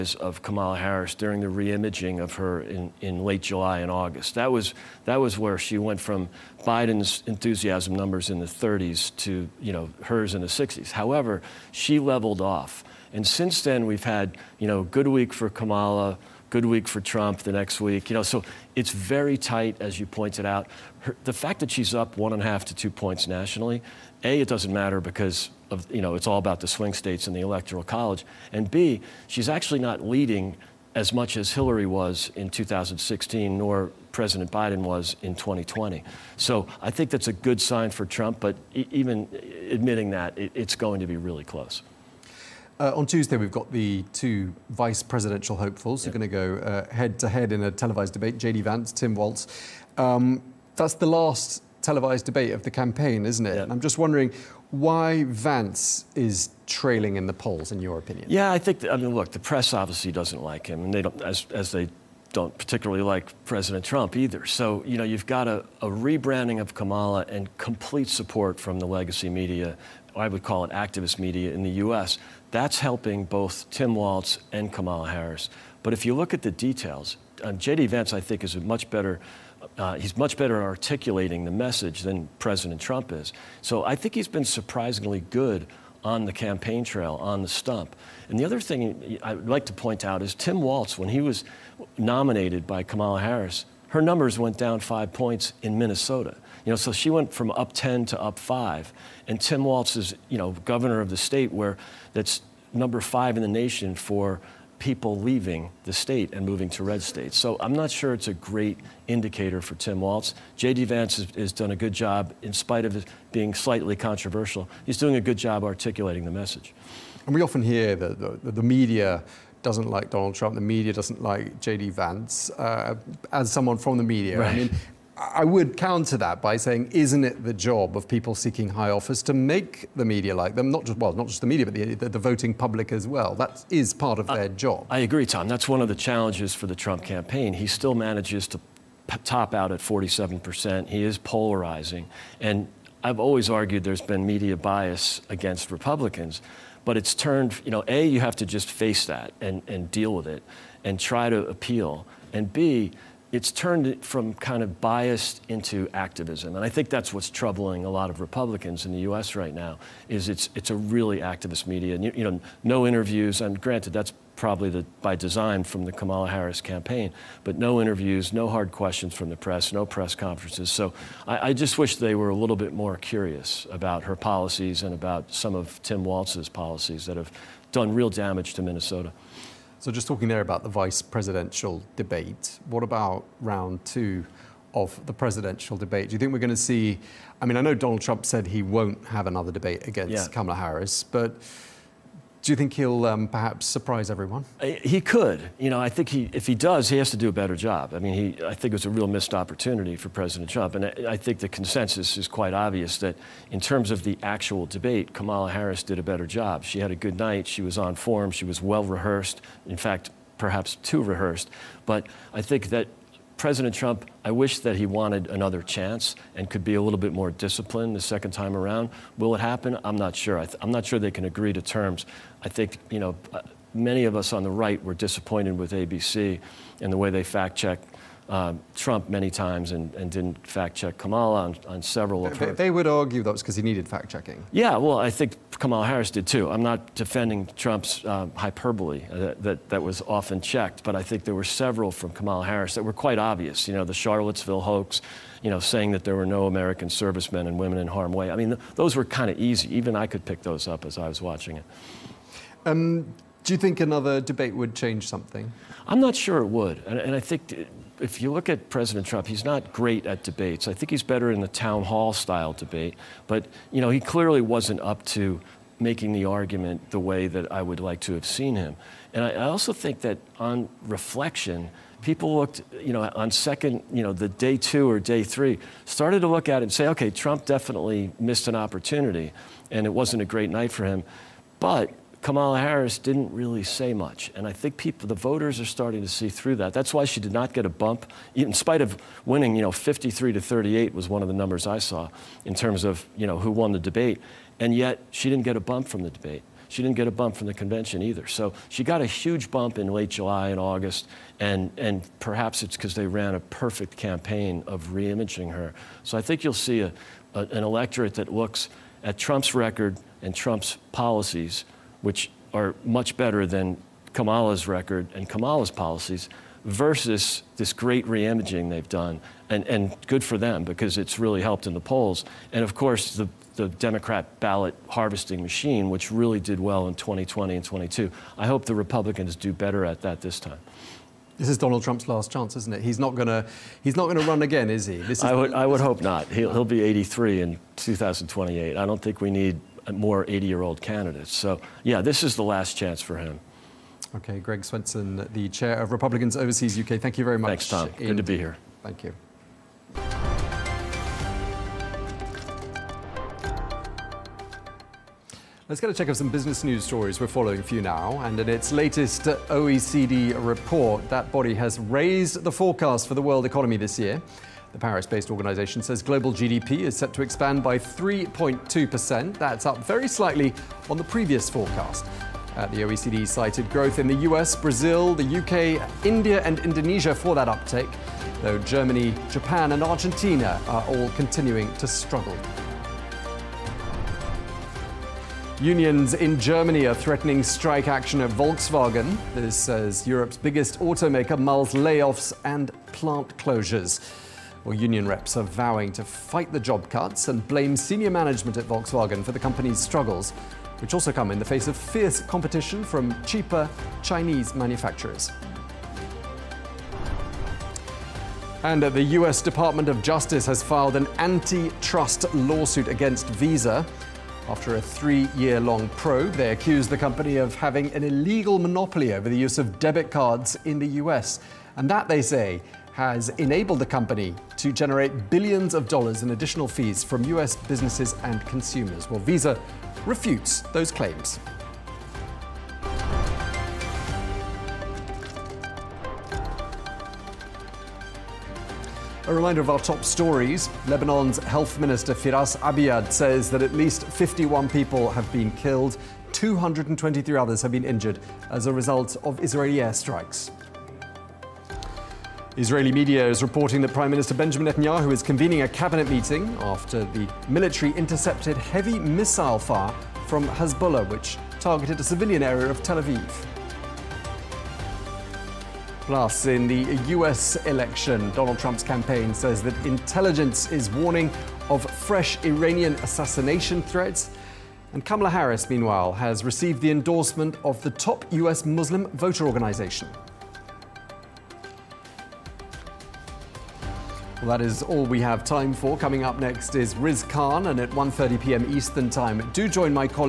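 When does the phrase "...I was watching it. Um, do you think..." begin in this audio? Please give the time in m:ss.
4:10.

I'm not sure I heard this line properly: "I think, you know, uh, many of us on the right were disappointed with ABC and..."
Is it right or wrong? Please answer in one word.
right.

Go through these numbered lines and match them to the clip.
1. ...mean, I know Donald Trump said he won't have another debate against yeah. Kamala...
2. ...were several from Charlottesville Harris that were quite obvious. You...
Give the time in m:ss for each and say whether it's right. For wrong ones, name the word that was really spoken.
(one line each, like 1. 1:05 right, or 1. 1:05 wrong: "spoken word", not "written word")
1. 3:07 right
2. 4:01 wrong: "Kamala", not "Charlottesville".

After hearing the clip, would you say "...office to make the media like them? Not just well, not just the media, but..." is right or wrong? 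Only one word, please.
right.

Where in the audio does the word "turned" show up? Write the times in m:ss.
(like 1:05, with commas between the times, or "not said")
2:27, 2:33.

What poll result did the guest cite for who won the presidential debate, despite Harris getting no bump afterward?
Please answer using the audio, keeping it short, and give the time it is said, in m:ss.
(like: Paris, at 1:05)
53 to 38, at 4:49.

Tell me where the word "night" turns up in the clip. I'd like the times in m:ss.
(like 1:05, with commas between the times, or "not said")
3:27, 4:40.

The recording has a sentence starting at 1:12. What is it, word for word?
That's helping both Tim Walz and Kamala Harris.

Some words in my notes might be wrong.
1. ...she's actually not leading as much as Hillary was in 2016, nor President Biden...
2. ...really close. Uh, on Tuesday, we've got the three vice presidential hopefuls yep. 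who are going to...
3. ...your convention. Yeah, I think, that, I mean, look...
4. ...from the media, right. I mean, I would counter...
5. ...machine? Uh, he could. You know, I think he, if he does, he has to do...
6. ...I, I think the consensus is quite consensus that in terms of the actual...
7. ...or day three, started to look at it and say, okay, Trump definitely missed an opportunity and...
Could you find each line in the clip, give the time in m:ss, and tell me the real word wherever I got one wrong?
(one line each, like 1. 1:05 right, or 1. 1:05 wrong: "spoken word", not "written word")
1. 0:29 right
2. 0:41 wrong: "two", not "three"
3. 0:57 wrong: "opinion", not "convention"
4. 2:03 right
5. 3:14 wrong: "everyone", not "machine"
6. 3:20 wrong: "obvious", not "consensus"
7. 4:34 right.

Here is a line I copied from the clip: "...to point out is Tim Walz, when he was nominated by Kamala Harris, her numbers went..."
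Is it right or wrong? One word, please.
right.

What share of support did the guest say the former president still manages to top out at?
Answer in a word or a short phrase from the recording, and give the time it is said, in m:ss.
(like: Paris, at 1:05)
47%, at 2:19.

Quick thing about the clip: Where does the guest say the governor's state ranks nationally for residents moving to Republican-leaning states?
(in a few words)
number 5.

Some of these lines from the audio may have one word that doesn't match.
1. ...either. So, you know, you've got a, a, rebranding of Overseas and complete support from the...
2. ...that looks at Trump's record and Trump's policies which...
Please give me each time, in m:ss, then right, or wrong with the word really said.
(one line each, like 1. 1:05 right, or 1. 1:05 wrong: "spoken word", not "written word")
1. 1:04 wrong: "Kamala", not "Overseas"
2. 5:08 right.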